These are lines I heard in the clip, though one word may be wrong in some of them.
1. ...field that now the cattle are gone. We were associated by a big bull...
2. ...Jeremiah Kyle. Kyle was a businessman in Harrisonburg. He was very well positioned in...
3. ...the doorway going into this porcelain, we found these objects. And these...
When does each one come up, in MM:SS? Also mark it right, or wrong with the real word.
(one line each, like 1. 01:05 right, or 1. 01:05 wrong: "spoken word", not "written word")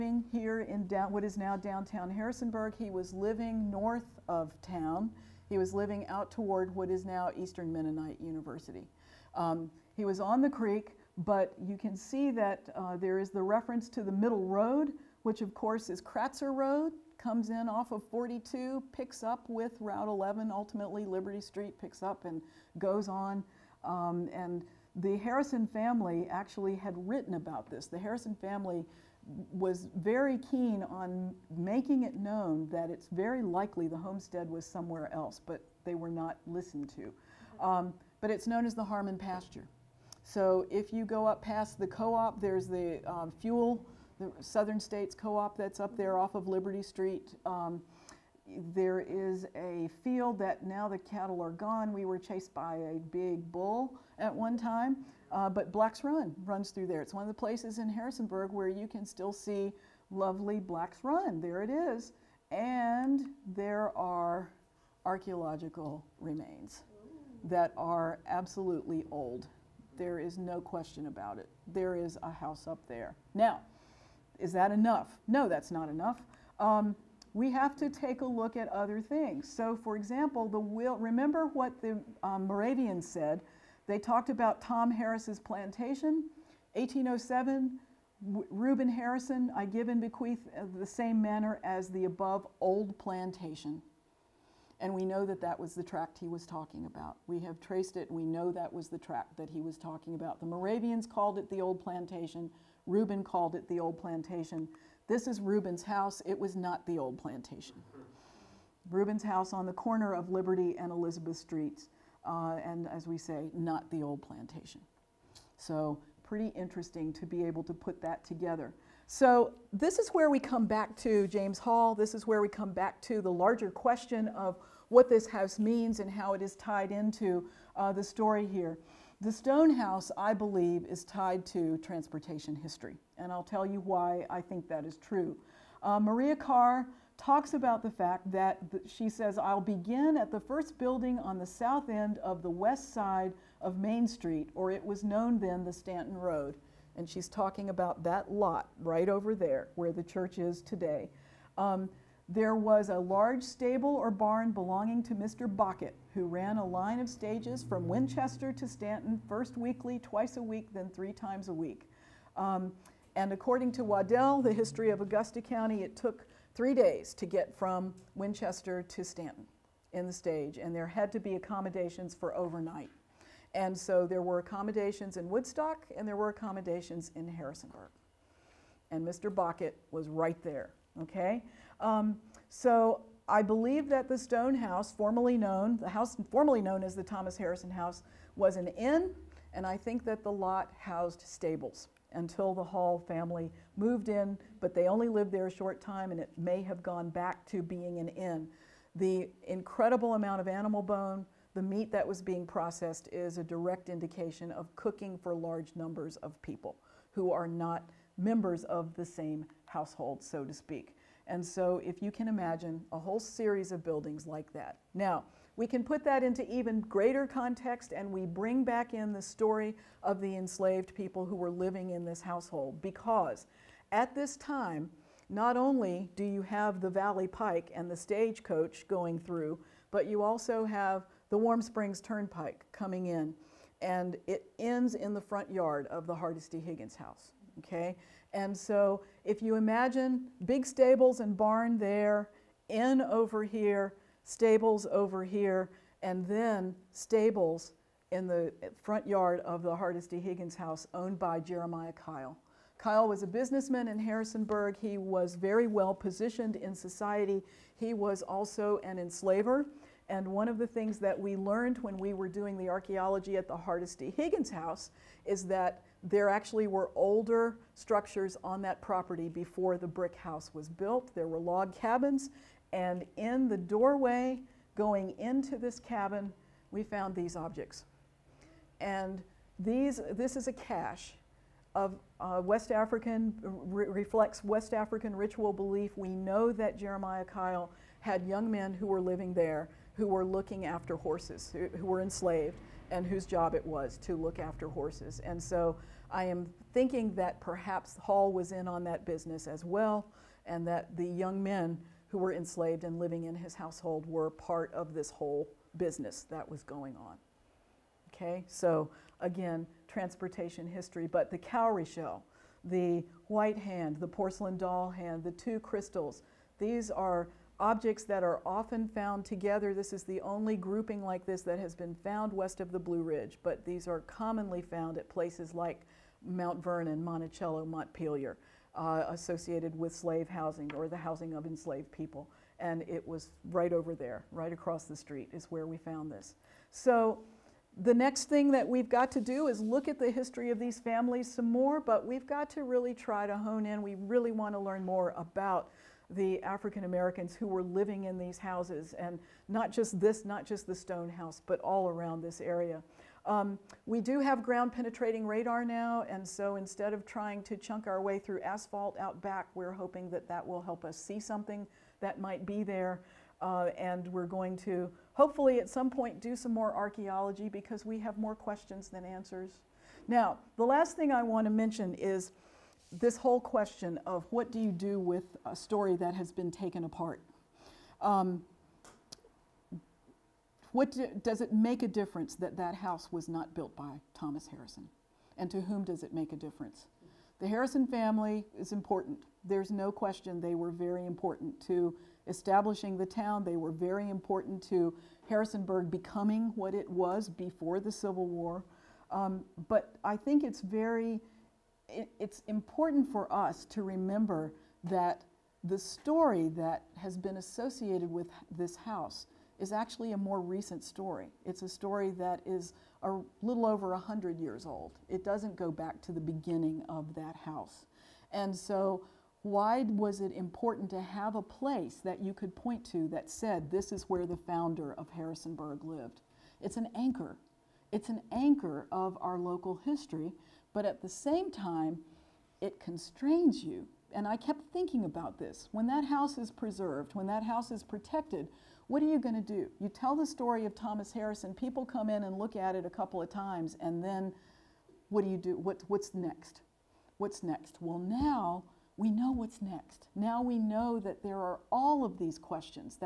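1. 00:50 wrong: "chased", not "associated"
2. 04:11 right
3. 04:33 wrong: "cabin", not "porcelain".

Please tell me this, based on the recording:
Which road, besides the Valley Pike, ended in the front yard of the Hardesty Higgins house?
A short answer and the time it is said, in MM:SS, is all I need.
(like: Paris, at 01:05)
Warm Springs Turnpike, at 03:51.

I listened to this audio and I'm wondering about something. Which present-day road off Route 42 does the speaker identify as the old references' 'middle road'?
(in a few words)
Kratzer Road.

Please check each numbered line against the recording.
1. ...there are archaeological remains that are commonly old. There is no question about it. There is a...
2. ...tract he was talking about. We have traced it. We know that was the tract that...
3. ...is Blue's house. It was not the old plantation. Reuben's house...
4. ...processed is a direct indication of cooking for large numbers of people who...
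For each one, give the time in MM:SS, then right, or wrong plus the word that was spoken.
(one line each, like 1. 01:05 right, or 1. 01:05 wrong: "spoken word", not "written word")
1. 01:03 wrong: "absolutely", not "commonly"
2. 01:35 right
3. 01:45 wrong: "Reuben", not "Blue"
4. 03:22 right.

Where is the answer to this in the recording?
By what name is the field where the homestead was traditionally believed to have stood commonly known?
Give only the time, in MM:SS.
00:38.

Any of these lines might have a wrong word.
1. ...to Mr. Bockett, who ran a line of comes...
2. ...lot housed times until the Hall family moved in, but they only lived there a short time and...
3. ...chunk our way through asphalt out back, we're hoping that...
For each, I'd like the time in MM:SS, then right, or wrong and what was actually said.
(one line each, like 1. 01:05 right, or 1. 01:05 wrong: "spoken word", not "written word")
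1. 02:35 wrong: "stages", not "comes"
2. 03:10 wrong: "stables", not "times"
3. 05:57 right.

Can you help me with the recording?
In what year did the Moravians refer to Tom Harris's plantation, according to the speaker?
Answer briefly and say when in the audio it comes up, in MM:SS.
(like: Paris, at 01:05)
1807, at 01:26.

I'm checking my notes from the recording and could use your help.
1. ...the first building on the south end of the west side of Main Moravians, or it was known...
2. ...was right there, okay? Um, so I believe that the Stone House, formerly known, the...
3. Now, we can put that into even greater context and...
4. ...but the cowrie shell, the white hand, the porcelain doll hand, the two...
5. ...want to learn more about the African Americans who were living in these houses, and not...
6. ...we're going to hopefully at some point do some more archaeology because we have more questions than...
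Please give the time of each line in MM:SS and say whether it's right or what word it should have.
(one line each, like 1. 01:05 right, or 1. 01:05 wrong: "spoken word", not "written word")
1. 02:20 wrong: "Street", not "Moravians"
2. 02:59 right
3. 03:34 right
4. 05:11 right
5. 05:44 right
6. 06:04 right.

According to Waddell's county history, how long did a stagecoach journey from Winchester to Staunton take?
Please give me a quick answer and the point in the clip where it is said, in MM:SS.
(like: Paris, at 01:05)
3 days, at 02:46.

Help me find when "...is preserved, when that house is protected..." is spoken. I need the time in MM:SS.
07:16.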